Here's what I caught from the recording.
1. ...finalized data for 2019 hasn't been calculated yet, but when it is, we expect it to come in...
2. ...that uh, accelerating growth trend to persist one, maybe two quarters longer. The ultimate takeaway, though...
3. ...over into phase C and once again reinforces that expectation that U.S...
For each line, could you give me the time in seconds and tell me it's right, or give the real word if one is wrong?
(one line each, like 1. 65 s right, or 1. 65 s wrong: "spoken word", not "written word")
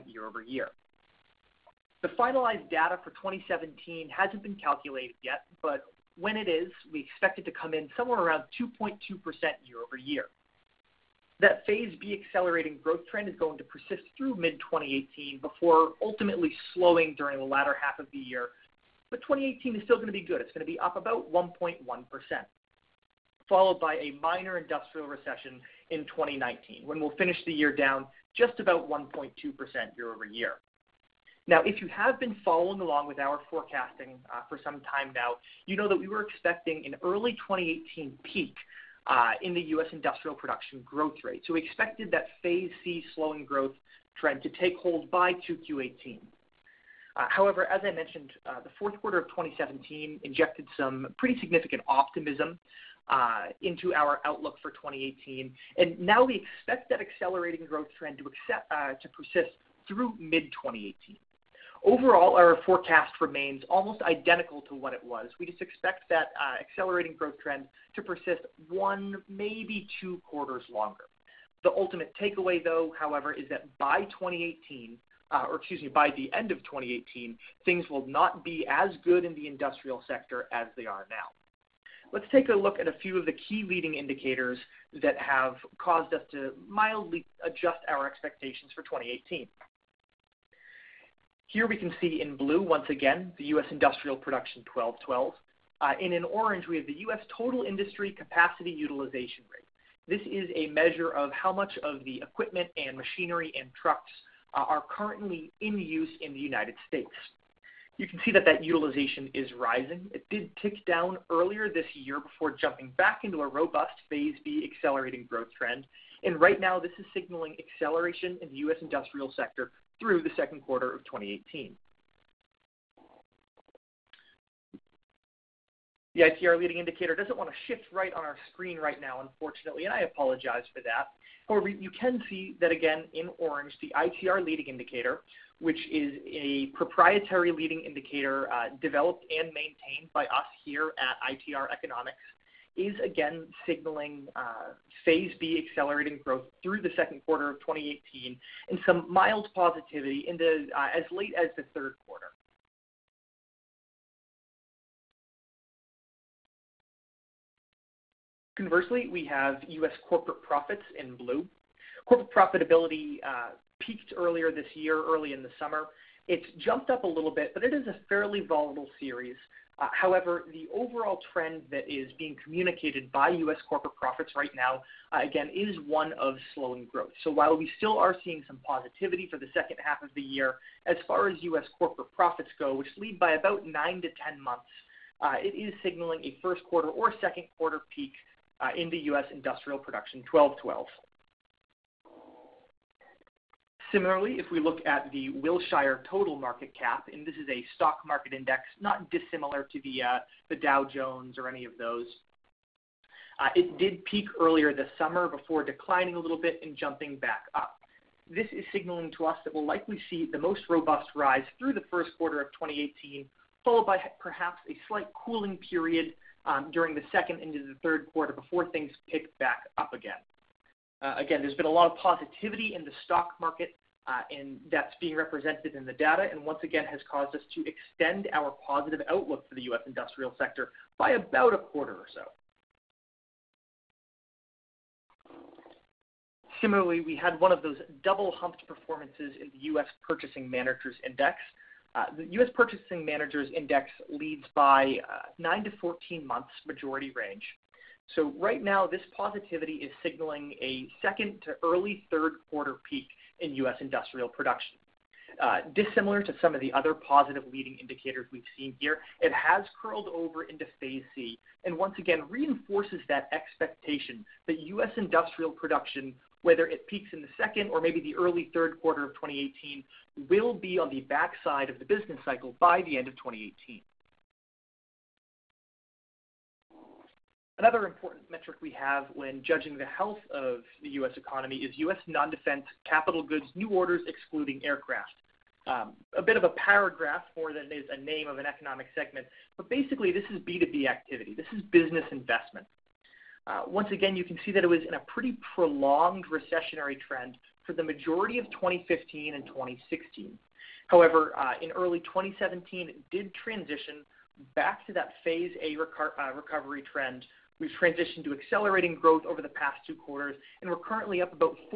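1. 2 s wrong: "2017", not "2019"
2. 66 s right
3. 260 s right.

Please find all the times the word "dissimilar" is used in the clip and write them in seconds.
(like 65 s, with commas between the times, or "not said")
199 s, 255 s.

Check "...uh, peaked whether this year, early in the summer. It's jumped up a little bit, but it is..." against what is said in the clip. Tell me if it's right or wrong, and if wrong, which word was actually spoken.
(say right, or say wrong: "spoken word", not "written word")
wrong: "earlier", not "whether".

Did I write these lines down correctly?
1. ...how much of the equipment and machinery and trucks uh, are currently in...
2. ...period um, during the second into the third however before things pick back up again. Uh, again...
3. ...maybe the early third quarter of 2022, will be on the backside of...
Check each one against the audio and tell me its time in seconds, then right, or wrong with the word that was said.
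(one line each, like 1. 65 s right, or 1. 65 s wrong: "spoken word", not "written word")
1. 101 s right
2. 215 s wrong: "quarter", not "however"
3. 267 s wrong: "2018", not "2022".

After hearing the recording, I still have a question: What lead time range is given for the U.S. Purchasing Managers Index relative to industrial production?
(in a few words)
9 to 14 months.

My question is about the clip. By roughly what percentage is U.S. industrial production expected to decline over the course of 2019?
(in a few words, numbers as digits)
1.2%.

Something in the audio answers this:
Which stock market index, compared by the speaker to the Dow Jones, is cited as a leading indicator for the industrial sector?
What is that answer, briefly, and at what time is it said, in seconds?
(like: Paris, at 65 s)
Wilshire total market cap, at 195 s.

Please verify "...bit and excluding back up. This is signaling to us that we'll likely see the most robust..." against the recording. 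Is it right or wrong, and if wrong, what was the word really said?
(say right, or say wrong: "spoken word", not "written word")
wrong: "jumping", not "excluding".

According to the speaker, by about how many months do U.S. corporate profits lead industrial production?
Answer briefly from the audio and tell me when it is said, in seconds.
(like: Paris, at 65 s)
9 to 10 months, at 183 s.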